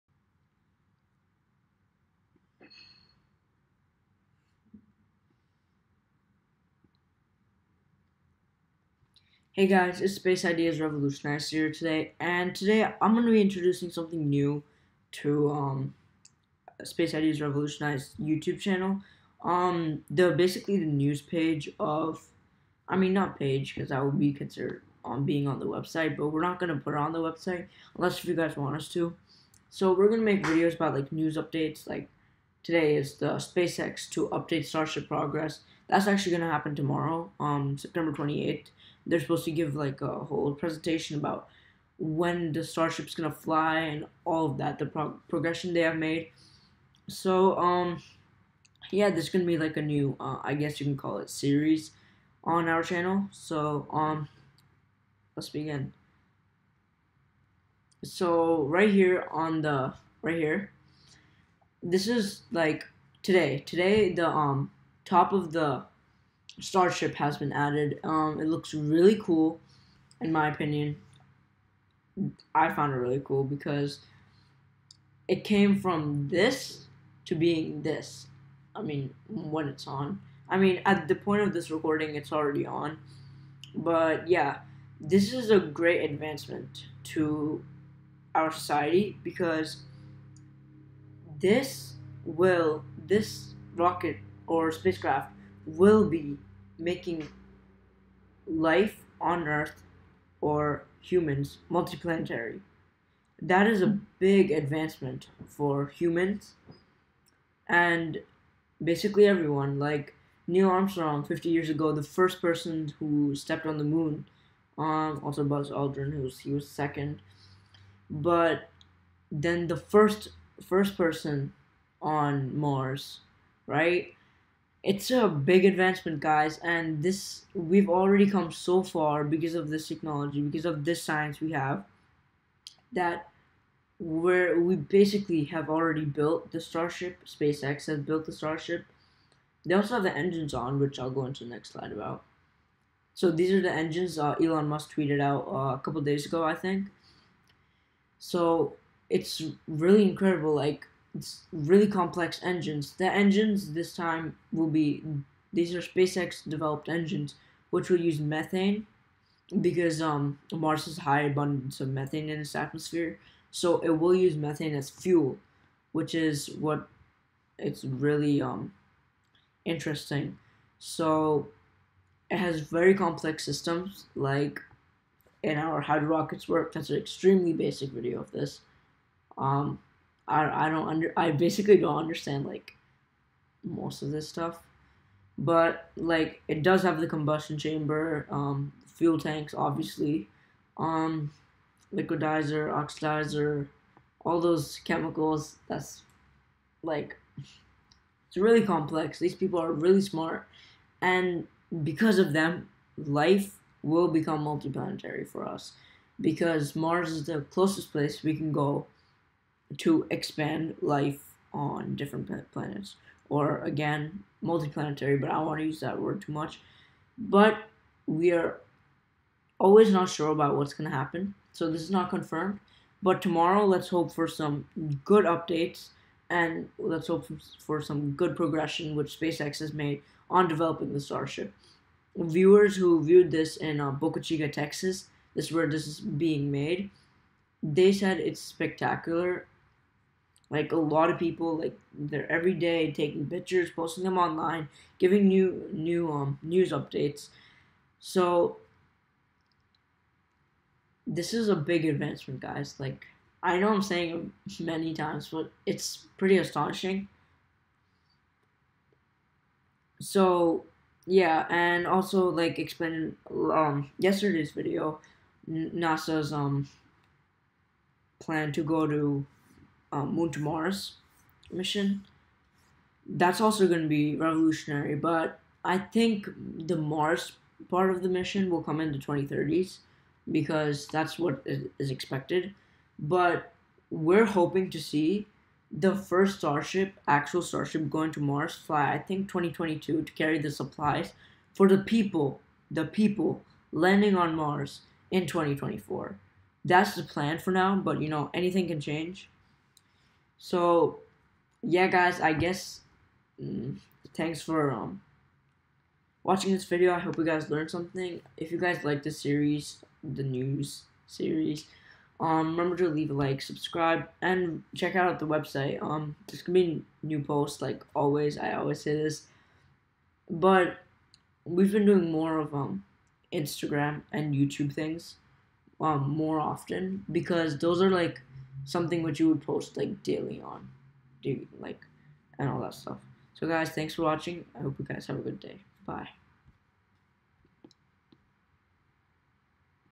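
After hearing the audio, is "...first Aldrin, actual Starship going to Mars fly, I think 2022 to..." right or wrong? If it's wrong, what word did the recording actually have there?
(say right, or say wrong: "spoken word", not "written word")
wrong: "Starship", not "Aldrin".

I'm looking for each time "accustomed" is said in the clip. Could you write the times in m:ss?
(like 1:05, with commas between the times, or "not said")
not said.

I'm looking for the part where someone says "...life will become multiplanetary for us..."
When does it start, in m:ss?
3:22.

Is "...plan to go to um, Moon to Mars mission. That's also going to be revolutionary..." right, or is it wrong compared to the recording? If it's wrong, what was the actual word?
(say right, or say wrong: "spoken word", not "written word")
right.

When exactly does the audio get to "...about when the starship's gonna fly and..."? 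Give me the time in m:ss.
0:41.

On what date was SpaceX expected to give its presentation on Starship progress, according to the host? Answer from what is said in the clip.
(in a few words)
September 28th.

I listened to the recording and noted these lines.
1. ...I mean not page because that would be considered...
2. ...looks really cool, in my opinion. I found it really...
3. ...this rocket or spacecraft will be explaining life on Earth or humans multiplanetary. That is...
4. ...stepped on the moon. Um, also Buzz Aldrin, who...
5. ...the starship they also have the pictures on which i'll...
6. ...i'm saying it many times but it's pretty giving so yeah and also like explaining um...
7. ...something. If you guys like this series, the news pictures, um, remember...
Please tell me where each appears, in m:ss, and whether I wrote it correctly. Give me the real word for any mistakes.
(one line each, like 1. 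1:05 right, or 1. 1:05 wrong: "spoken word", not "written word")
1. 0:22 right
2. 1:08 right
3. 1:33 wrong: "making", not "explaining"
4. 1:53 right
5. 2:18 wrong: "engines", not "pictures"
6. 4:13 wrong: "astonishing", not "giving"
7. 5:07 wrong: "series", not "pictures".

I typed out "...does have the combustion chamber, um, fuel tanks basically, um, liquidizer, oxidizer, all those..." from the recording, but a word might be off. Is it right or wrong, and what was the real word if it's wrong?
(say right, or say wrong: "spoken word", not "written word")
wrong: "obviously", not "basically".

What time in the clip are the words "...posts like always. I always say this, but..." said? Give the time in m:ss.
5:17.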